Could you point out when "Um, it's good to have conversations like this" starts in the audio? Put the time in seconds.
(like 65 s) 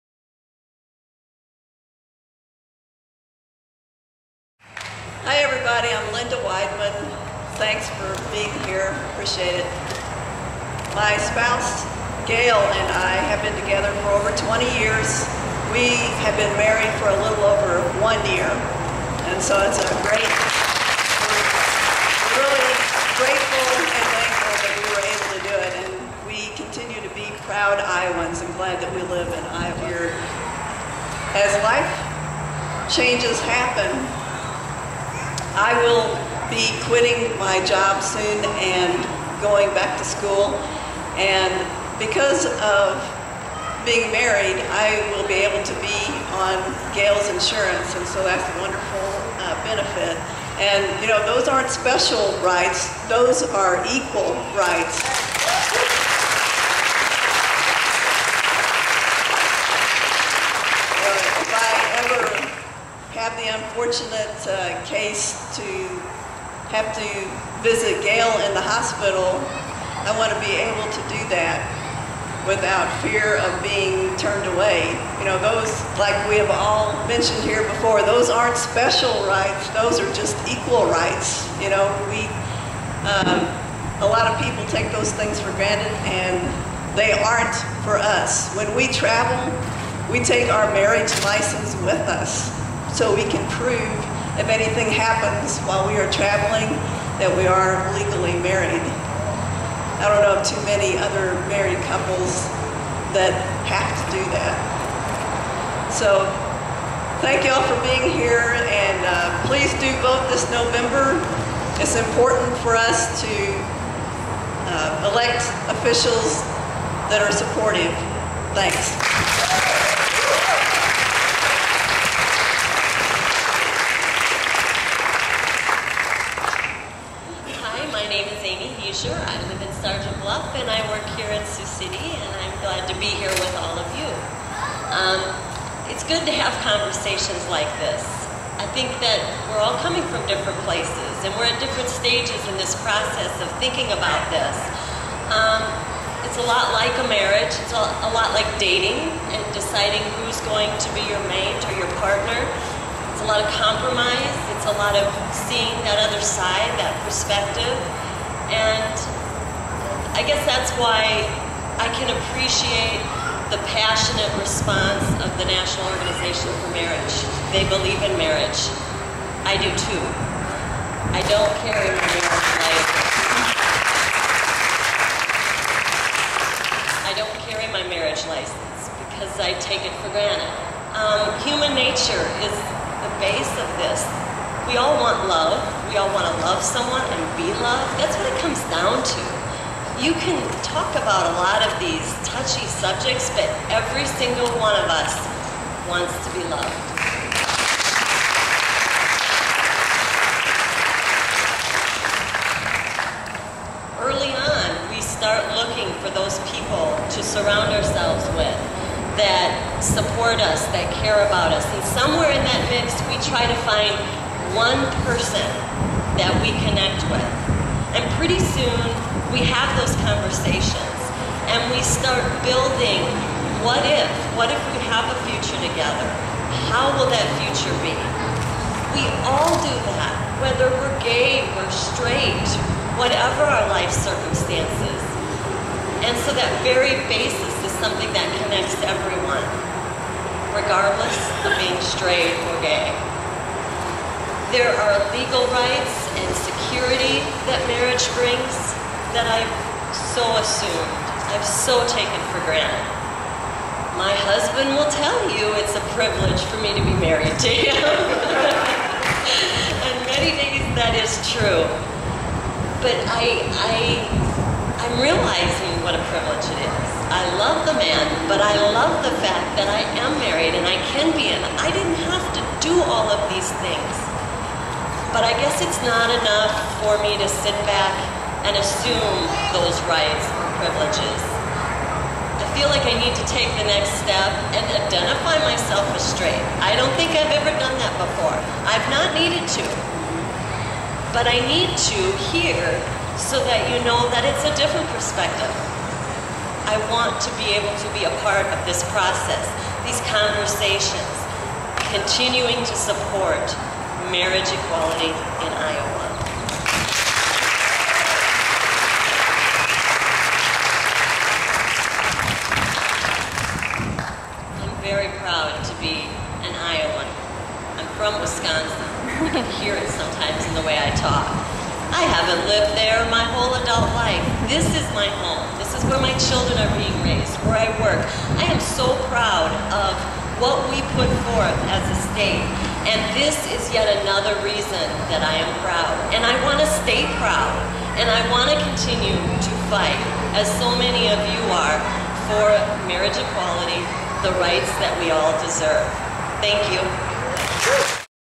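134 s.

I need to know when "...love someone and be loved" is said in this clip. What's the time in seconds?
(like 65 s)
186 s.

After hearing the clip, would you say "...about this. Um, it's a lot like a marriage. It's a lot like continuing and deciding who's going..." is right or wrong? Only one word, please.
wrong.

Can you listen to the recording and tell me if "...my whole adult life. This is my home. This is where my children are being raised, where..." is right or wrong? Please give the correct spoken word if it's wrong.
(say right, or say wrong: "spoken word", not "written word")
right.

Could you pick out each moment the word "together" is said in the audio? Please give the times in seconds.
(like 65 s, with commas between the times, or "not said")
13 s, 225 s.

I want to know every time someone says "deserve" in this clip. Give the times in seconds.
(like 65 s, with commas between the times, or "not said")
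345 s.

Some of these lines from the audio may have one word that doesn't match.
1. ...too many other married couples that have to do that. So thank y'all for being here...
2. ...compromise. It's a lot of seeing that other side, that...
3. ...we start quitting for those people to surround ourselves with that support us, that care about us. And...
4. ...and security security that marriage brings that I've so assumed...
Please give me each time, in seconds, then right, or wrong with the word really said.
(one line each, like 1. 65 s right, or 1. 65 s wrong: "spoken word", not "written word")
1. 100 s right
2. 153 s right
3. 204 s wrong: "looking", not "quitting"
4. 246 s right.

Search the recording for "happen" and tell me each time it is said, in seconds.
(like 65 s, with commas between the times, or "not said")
33 s, 94 s.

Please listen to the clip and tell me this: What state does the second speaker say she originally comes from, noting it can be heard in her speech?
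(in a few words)
Wisconsin.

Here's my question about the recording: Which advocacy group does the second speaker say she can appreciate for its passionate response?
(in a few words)
National Organization for Marriage.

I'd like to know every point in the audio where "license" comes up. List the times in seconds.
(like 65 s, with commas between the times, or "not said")
91 s, 178 s.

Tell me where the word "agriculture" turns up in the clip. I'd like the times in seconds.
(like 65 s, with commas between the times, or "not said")
not said.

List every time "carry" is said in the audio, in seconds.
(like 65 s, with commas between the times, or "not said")
171 s, 177 s.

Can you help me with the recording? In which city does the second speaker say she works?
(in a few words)
Sioux City.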